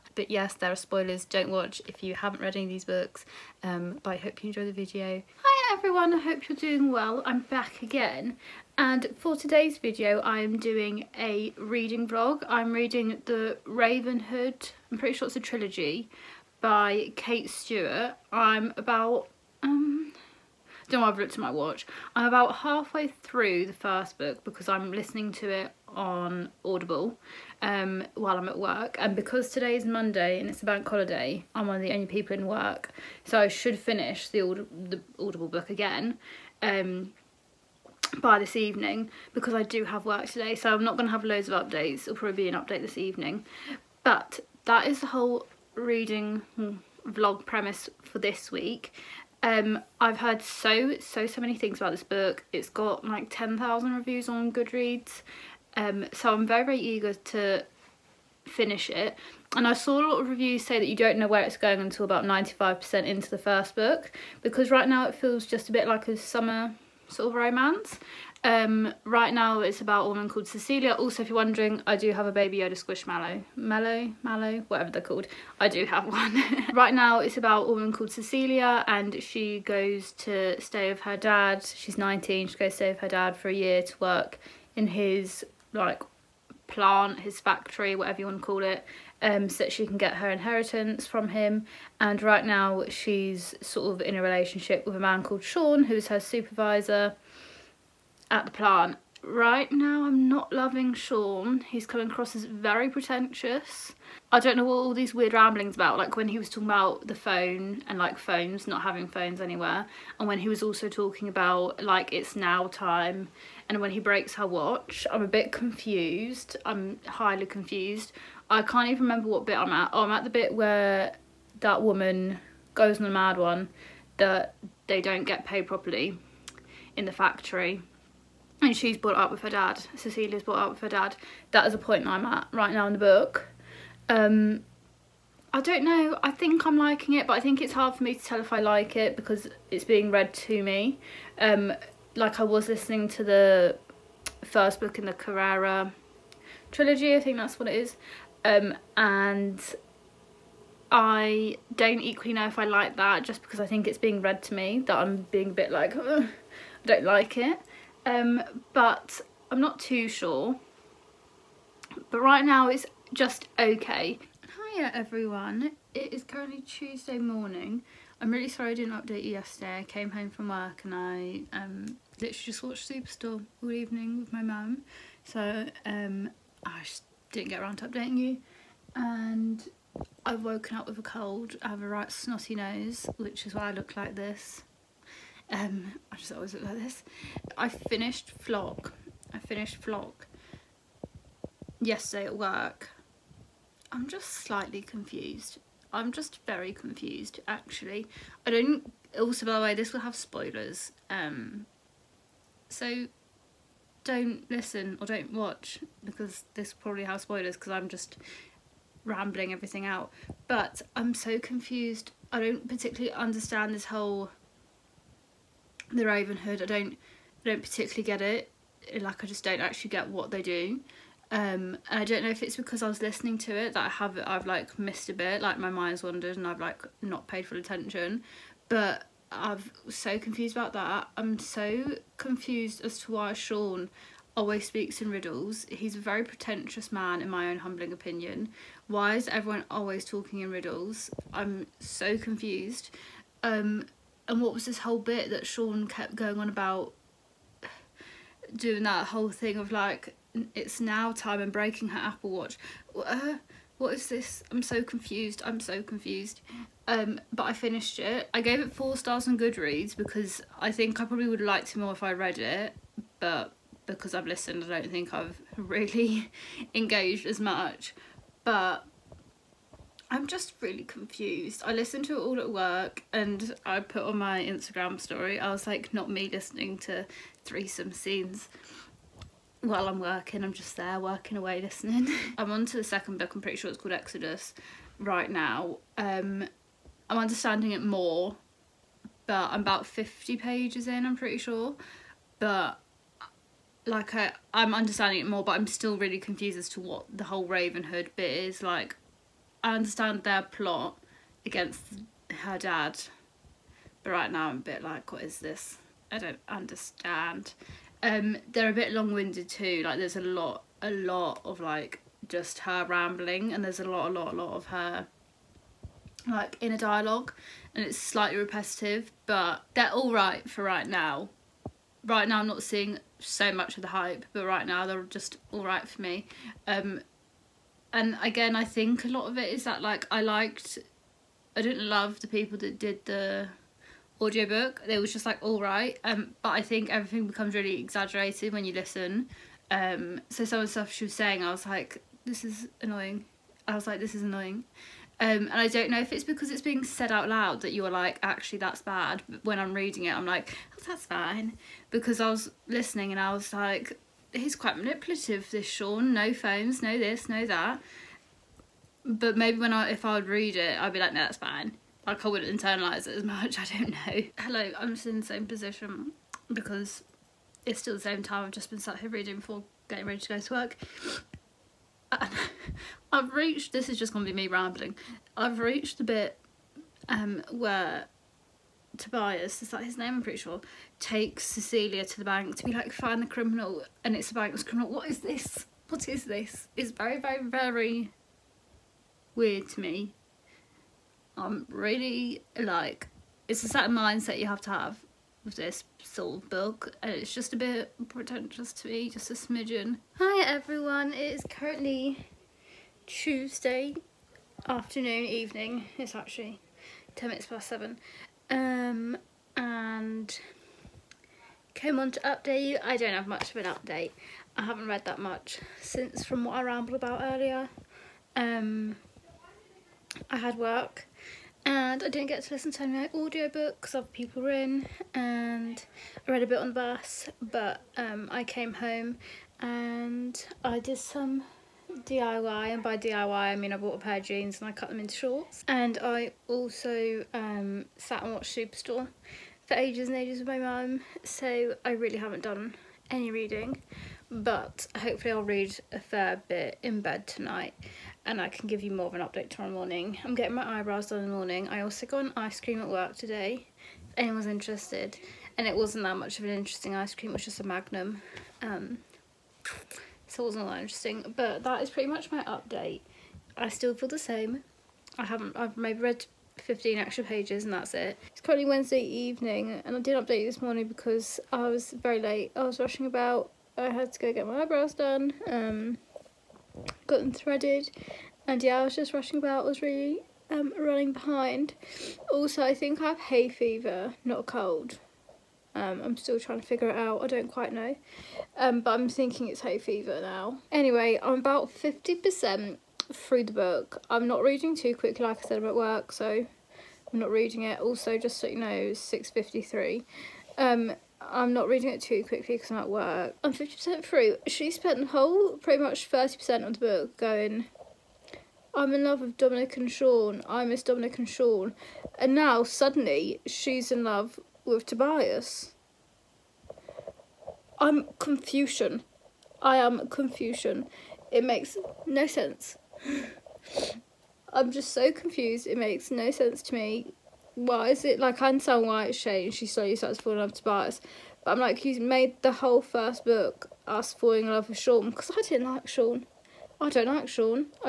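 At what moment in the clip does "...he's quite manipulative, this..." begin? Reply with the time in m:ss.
5:54.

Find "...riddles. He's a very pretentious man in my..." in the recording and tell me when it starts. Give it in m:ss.
3:55.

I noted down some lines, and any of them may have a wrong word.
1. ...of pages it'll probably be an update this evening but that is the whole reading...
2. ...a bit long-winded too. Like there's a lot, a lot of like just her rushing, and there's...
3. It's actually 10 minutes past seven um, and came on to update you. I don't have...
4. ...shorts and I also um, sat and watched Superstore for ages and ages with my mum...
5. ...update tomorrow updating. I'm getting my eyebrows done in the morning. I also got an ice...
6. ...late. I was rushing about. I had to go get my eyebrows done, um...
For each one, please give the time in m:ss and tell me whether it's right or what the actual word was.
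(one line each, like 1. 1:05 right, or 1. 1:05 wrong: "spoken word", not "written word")
1. 0:41 wrong: "updates", not "pages"
2. 5:08 wrong: "rambling", not "rushing"
3. 6:45 right
4. 7:15 right
5. 7:29 wrong: "morning", not "updating"
6. 7:52 right.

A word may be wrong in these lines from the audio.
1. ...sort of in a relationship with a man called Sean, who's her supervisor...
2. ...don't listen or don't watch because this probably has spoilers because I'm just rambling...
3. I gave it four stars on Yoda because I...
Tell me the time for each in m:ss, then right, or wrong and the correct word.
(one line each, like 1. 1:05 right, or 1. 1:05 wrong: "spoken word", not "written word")
1. 1:33 right
2. 3:24 right
3. 4:18 wrong: "Goodreads", not "Yoda".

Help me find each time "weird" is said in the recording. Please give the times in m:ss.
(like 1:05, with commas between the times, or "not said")
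1:45, 6:29.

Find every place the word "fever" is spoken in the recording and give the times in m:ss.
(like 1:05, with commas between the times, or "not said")
8:03, 8:09.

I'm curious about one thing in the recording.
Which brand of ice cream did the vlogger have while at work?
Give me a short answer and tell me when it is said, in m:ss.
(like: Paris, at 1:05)
Magnum, at 7:37.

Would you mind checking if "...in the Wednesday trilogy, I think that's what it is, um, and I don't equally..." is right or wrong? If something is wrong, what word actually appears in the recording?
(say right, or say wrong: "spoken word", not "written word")
wrong: "Carrera", not "Wednesday".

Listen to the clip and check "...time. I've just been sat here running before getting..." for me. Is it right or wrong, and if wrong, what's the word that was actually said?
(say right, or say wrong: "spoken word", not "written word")
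wrong: "reading", not "running".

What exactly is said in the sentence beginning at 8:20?
Um, I'm not reading it too quickly because I'm at work.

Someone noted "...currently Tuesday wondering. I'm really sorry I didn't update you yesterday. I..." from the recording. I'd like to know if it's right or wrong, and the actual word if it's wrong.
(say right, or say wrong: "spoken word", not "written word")
wrong: "morning", not "wondering".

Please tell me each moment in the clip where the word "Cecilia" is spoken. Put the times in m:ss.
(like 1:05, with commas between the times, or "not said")
1:10, 1:18, 2:09, 6:21.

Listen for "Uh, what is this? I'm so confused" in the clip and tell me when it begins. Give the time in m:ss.
4:12.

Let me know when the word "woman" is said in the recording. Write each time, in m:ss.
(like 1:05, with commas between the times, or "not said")
1:10, 1:17, 2:01.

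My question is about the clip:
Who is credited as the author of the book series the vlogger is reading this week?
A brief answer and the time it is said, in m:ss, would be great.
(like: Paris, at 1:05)
Kate Stewart, at 0:17.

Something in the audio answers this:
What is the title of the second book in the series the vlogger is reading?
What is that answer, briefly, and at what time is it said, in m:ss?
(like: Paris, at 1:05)
Exodus, at 4:43.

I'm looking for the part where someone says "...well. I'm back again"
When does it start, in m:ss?
0:06.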